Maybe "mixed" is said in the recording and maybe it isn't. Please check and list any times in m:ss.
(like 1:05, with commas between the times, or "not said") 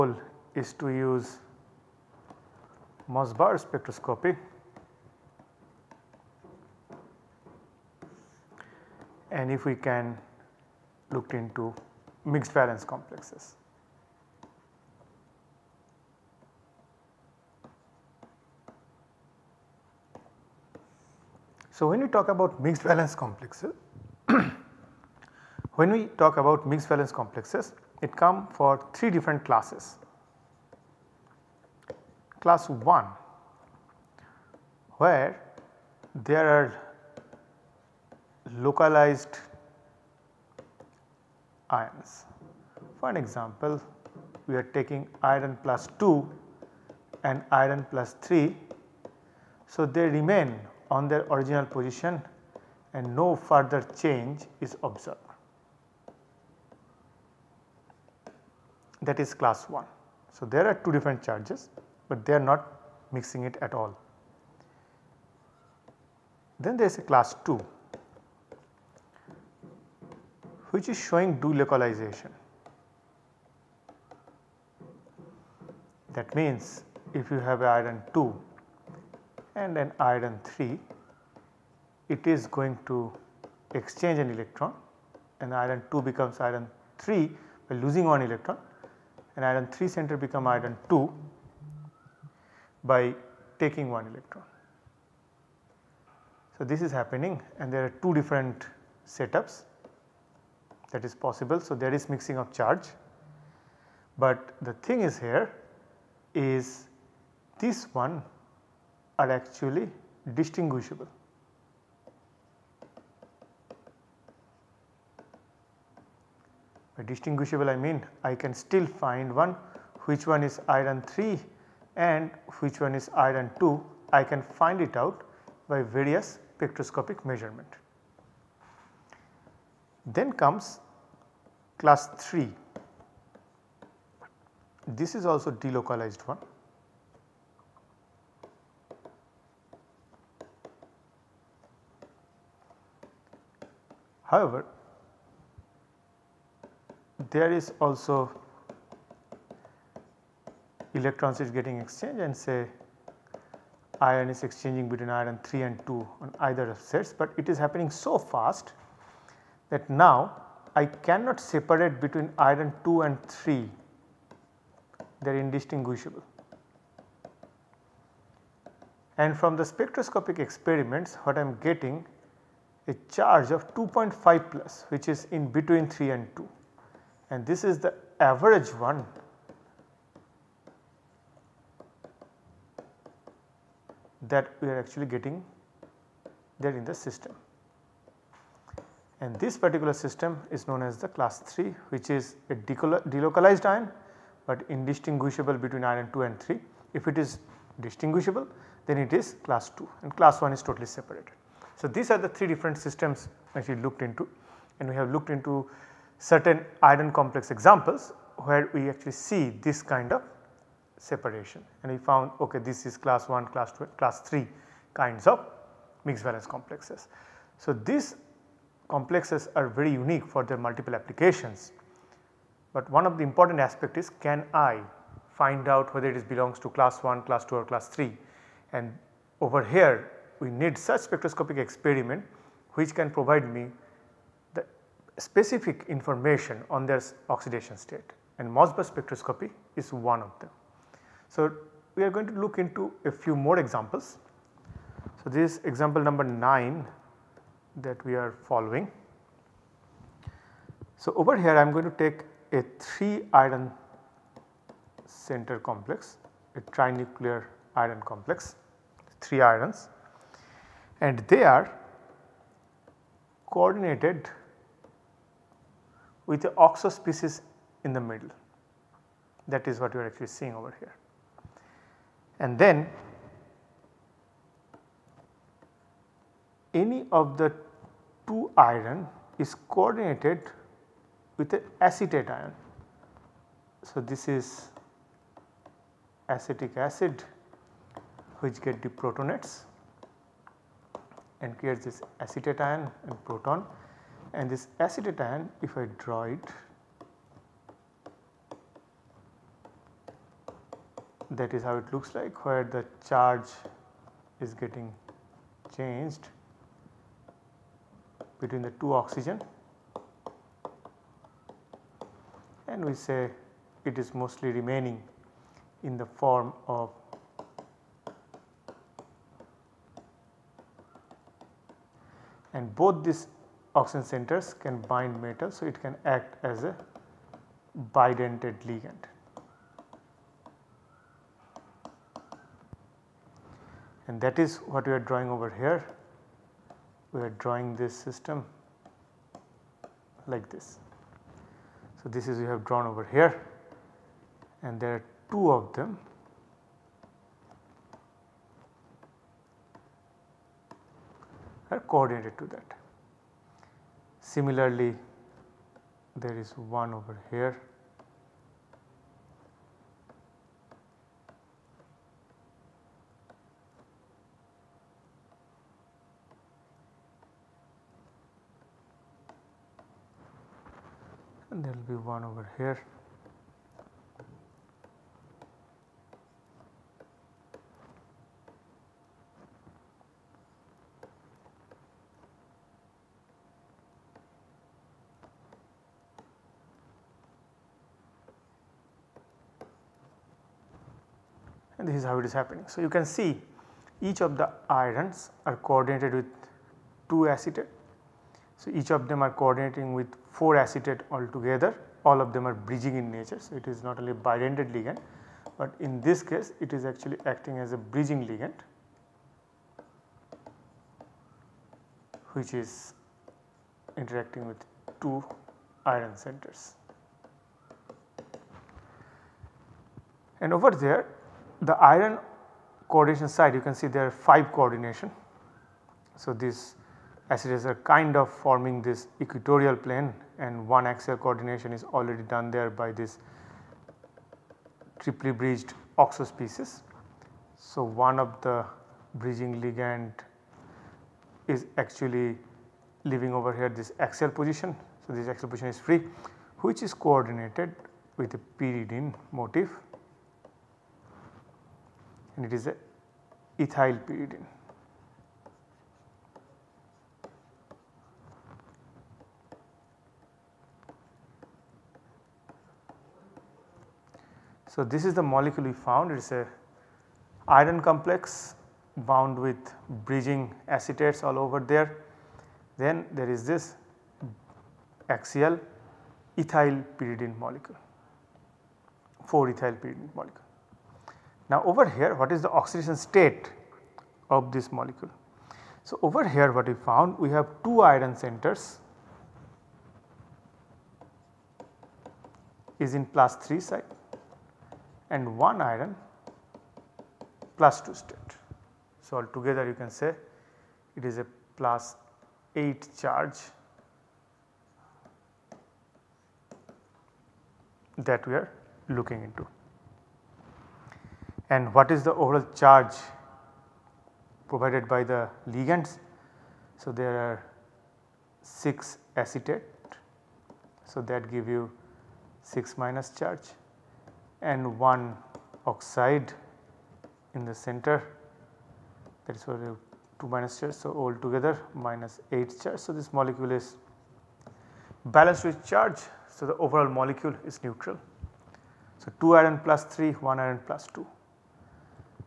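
0:12, 0:22, 0:26, 3:36.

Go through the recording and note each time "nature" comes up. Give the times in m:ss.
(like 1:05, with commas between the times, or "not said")
6:43.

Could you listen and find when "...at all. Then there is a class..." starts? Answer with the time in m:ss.
1:03.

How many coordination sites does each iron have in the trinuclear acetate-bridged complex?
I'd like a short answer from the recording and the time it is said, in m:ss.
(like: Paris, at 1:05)
5, at 7:04.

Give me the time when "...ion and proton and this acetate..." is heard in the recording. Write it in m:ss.
4:52.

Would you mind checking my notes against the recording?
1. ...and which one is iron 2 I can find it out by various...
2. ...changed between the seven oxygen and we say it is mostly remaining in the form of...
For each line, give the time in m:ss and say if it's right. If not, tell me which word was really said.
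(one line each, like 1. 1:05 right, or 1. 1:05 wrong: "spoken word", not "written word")
1. 2:01 right
2. 5:05 wrong: "two", not "seven".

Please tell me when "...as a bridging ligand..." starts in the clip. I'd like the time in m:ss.
6:47.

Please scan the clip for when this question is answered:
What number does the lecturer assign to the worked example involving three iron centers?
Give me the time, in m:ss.
4:05.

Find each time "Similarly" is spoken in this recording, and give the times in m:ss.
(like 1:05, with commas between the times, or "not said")
5:54.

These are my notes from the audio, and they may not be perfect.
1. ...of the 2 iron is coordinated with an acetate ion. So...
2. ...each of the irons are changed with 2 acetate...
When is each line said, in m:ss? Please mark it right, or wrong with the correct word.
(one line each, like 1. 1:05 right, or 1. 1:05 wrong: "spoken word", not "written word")
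1. 4:37 right
2. 6:34 wrong: "coordinated", not "changed".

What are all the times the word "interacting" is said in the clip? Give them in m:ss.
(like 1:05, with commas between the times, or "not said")
6:53.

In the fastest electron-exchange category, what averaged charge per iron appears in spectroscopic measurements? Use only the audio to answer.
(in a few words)
2.5+.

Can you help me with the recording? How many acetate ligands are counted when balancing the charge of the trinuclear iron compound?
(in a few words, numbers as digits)
6.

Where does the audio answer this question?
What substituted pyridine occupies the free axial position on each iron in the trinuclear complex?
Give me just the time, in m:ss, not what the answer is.
7:59.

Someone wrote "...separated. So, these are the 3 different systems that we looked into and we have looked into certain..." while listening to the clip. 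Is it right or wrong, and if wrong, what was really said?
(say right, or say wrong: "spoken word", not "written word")
right.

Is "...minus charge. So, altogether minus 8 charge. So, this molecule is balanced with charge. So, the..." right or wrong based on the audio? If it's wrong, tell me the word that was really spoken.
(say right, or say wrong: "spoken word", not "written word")
right.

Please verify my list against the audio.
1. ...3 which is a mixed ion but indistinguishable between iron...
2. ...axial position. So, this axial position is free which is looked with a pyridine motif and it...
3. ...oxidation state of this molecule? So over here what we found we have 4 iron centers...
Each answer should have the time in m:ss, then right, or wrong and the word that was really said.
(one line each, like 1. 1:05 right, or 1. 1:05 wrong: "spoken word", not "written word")
1. 3:11 wrong: "delocalized", not "mixed"
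2. 7:24 wrong: "coordinated", not "looked"
3. 8:02 wrong: "2", not "4".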